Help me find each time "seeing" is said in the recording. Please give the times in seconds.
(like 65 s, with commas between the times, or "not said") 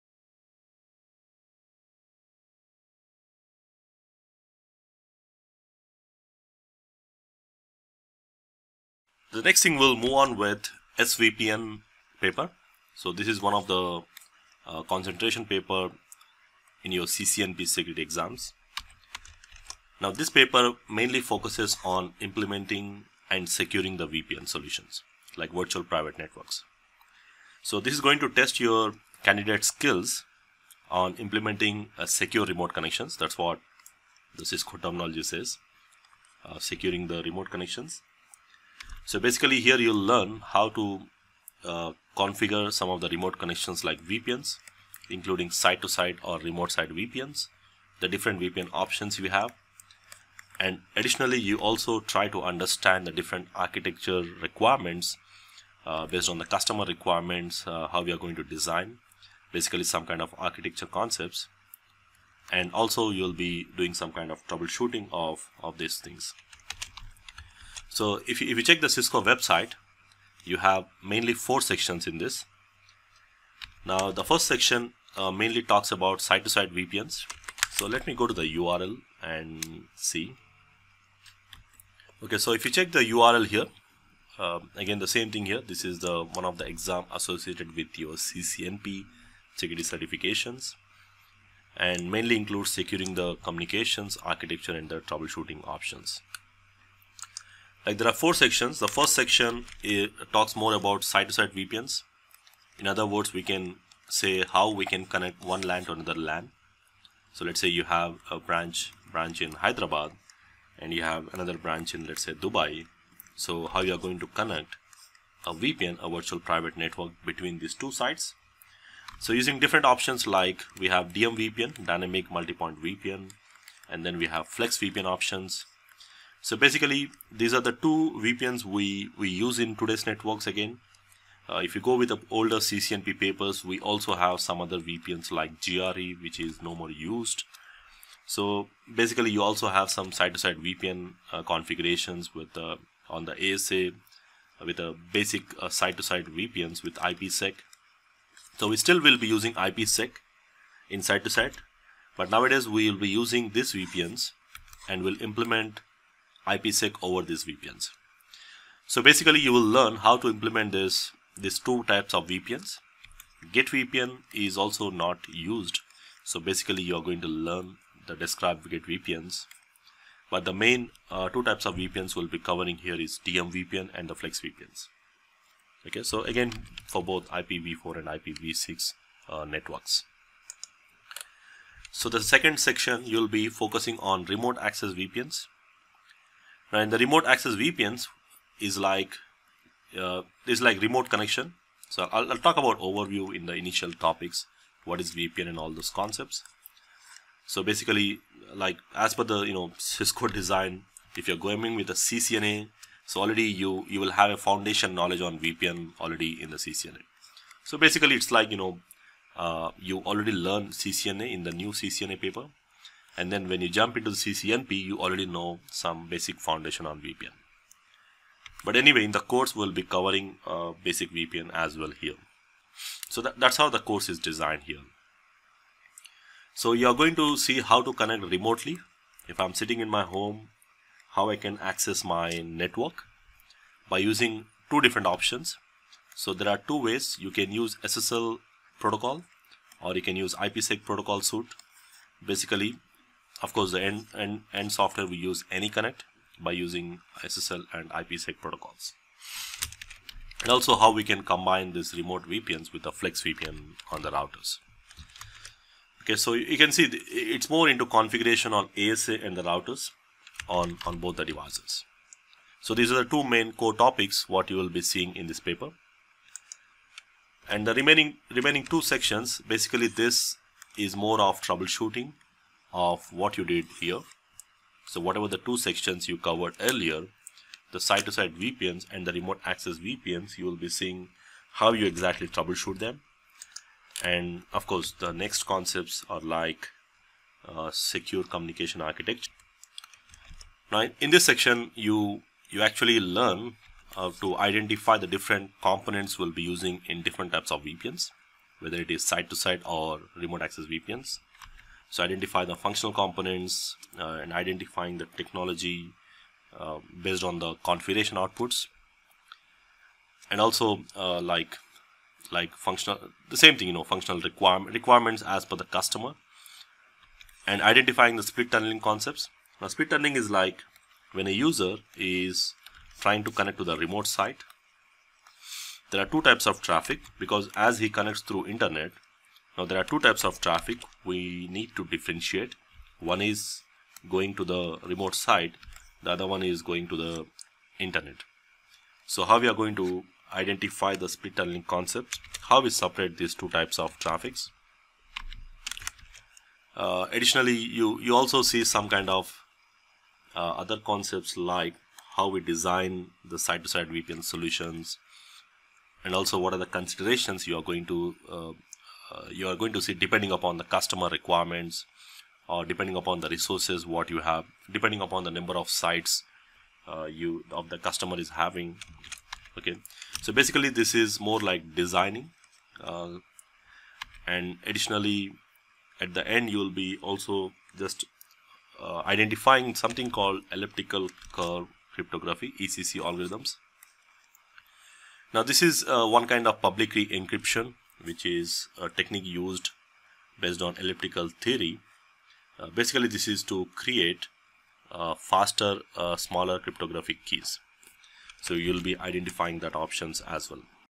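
264 s, 280 s.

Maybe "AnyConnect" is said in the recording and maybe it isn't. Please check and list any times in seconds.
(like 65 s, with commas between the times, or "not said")
245 s.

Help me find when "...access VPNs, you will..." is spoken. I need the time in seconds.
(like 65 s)
279 s.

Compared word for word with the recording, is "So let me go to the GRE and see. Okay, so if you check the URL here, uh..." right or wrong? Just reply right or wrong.
wrong.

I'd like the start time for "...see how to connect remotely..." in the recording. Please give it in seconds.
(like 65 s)
227 s.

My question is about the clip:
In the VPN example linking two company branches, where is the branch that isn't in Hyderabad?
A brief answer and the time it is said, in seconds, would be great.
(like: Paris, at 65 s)
Dubai, at 112 s.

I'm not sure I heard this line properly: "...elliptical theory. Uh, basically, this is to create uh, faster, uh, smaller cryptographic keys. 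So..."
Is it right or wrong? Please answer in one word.
right.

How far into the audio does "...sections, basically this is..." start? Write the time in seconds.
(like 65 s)
268 s.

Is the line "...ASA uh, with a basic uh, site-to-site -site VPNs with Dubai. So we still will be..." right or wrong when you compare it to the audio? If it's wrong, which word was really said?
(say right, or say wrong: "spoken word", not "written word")
wrong: "IPsec", not "Dubai".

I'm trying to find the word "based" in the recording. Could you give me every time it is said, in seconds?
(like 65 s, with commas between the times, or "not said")
56 s, 307 s, 390 s.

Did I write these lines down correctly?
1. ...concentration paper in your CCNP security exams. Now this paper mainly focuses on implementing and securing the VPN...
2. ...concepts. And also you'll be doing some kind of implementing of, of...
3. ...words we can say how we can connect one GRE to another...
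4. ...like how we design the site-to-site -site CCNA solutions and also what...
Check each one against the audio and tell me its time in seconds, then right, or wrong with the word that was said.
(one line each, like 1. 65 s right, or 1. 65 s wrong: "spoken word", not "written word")
1. 14 s right
2. 60 s wrong: "troubleshooting", not "implementing"
3. 103 s wrong: "LAN", not "GRE"
4. 351 s wrong: "VPN", not "CCNA".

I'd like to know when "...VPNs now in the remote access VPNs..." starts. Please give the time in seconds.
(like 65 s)
184 s.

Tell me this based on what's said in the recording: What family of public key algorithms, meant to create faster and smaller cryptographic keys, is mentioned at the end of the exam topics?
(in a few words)
elliptical curve cryptography.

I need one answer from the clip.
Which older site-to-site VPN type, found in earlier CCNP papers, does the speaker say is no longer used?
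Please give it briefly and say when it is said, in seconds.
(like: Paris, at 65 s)
GRE, at 135 s.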